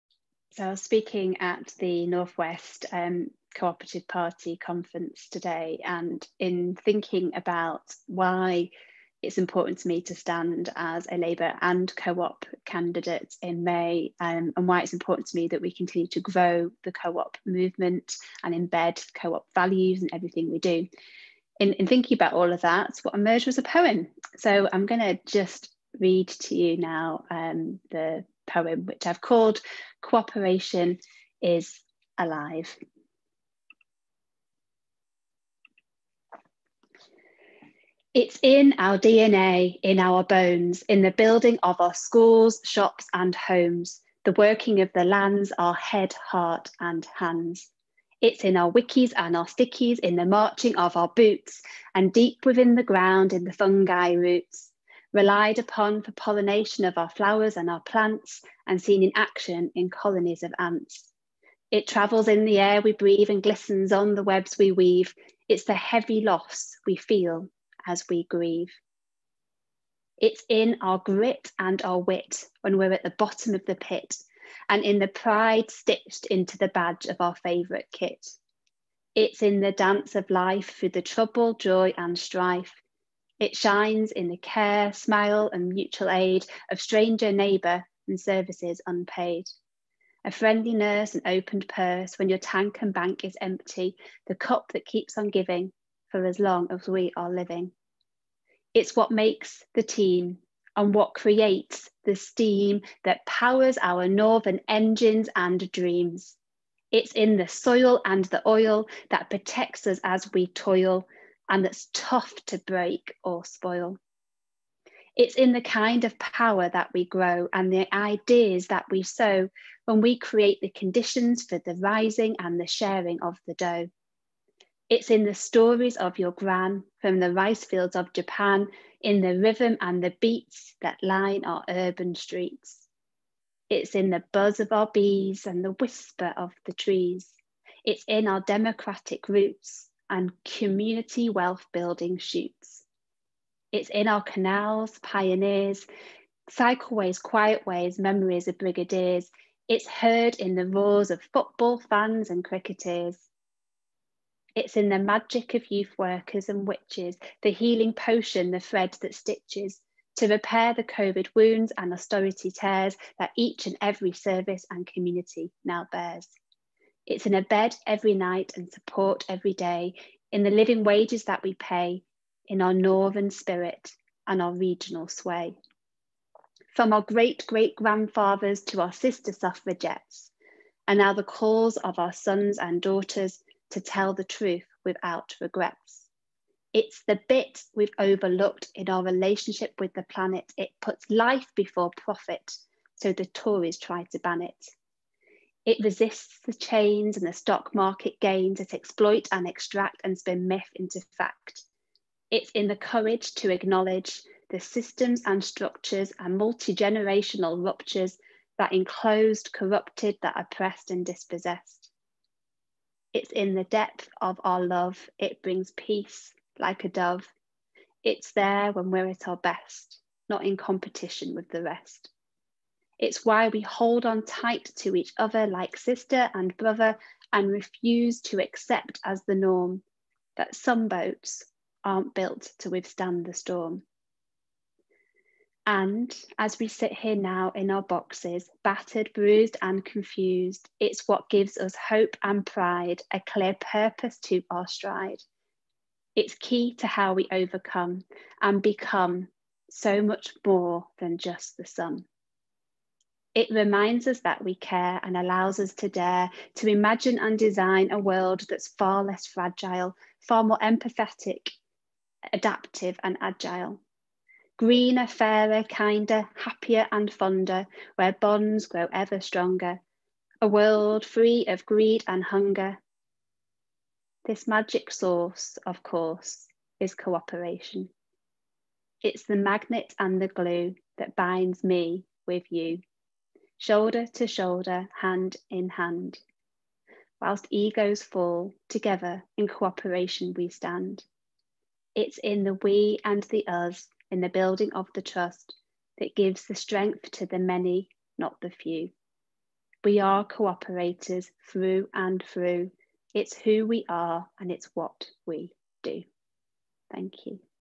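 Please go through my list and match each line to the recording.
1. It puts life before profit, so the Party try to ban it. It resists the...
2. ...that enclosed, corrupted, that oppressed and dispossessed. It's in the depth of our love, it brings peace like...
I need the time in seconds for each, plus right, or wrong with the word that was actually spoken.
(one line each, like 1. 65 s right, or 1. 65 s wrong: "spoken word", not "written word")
1. 190 s wrong: "Tories", not "Party"
2. 208 s right.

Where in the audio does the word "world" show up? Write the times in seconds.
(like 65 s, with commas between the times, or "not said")
257 s, 270 s.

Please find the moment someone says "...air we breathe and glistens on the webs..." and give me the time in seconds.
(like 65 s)
62 s.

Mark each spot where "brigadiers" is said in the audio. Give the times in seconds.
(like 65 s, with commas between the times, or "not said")
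148 s.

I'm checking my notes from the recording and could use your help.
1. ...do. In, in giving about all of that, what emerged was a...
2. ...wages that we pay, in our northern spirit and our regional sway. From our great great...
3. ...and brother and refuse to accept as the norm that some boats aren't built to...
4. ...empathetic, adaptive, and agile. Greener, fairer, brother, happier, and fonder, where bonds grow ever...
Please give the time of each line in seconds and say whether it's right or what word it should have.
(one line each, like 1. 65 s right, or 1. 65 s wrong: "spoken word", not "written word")
1. 20 s wrong: "thinking", not "giving"
2. 170 s right
3. 226 s right
4. 260 s wrong: "kinder", not "brother".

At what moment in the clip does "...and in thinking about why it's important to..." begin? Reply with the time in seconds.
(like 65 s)
5 s.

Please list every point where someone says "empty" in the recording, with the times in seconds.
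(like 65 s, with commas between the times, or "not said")
93 s.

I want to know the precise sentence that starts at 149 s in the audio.
It's heard in the roars of football fans and cricketers.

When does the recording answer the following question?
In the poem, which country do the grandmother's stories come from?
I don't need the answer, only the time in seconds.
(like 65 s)
128 s.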